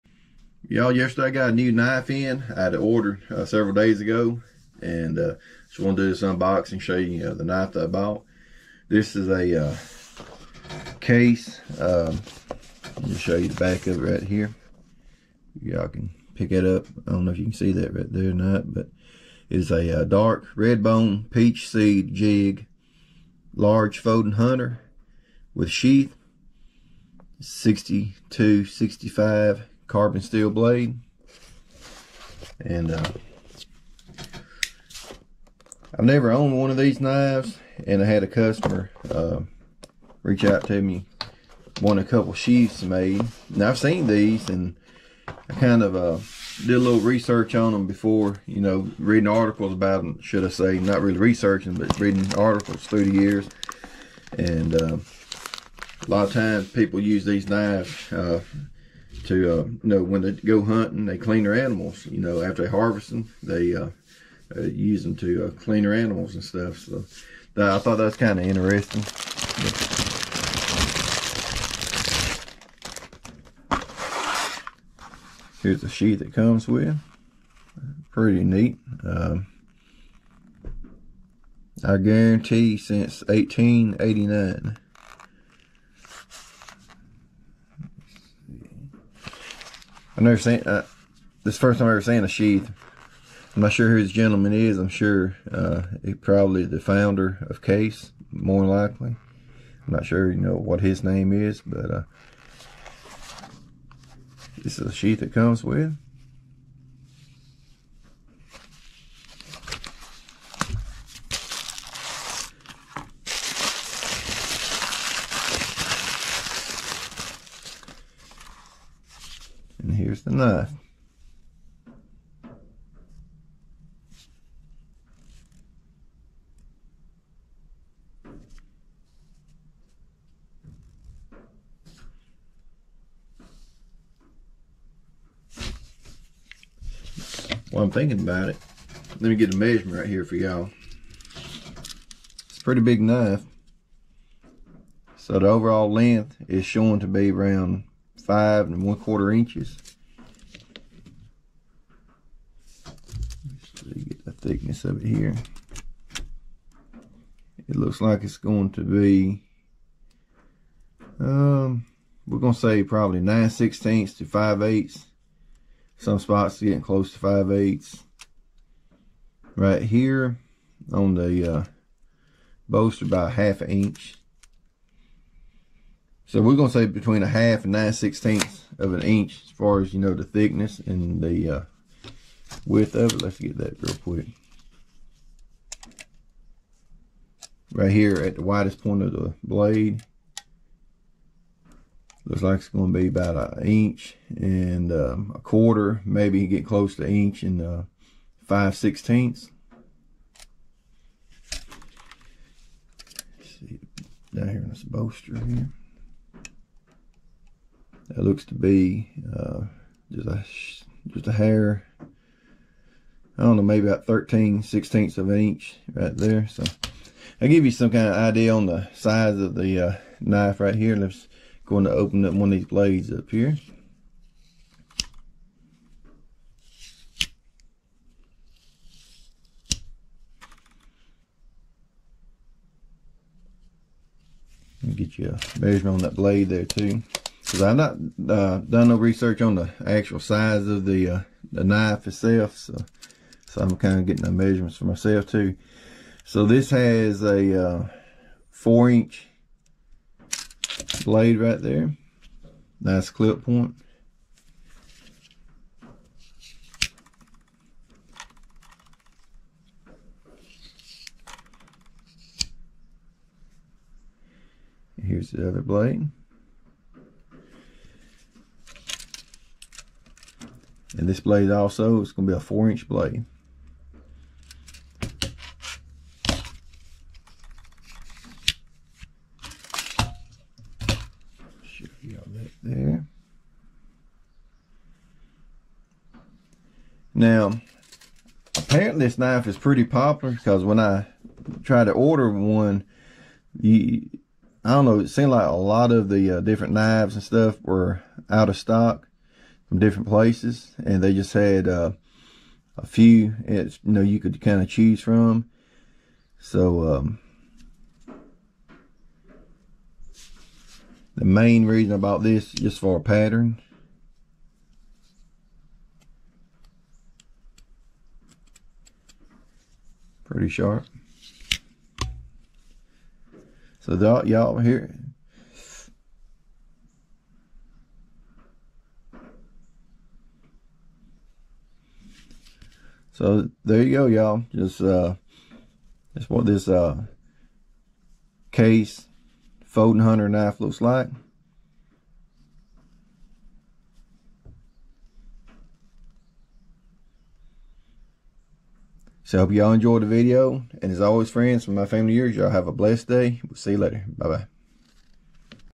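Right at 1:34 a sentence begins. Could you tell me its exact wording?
I'm sure uh, he probably the founder of Case, more likely.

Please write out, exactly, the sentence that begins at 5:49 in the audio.
So hope y'all enjoyed the video.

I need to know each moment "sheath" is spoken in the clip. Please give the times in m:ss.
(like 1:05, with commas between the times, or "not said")
0:25, 0:42, 1:32, 1:44.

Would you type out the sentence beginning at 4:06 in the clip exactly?
So this has a uh, four inch blade right there.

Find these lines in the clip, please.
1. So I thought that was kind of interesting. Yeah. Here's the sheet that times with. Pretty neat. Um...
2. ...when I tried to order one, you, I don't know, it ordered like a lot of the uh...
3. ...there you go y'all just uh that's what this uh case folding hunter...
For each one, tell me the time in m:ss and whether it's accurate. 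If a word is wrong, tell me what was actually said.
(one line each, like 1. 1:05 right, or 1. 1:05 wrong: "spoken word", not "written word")
1. 1:06 wrong: "comes", not "times"
2. 4:50 wrong: "seemed", not "ordered"
3. 5:33 right.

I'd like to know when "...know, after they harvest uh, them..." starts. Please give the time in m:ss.
1:02.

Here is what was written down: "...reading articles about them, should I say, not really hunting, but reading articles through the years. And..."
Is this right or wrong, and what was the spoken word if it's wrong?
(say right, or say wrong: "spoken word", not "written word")
wrong: "researching", not "hunting".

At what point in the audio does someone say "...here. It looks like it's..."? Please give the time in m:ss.
2:35.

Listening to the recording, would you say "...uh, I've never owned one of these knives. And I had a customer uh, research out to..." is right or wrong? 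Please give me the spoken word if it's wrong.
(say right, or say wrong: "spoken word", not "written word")
wrong: "reach", not "research".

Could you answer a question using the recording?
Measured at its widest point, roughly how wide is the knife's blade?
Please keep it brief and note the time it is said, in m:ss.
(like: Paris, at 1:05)
1 1/4 inches, at 3:13.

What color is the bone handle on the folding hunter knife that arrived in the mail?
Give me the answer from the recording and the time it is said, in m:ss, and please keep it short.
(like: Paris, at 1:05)
Dark red, at 0:20.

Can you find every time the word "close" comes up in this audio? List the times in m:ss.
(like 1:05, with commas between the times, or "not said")
2:46, 3:16.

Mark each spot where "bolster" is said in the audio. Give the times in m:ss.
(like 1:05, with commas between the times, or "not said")
2:52, 3:24.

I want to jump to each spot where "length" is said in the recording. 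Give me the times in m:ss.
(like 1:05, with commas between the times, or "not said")
2:25.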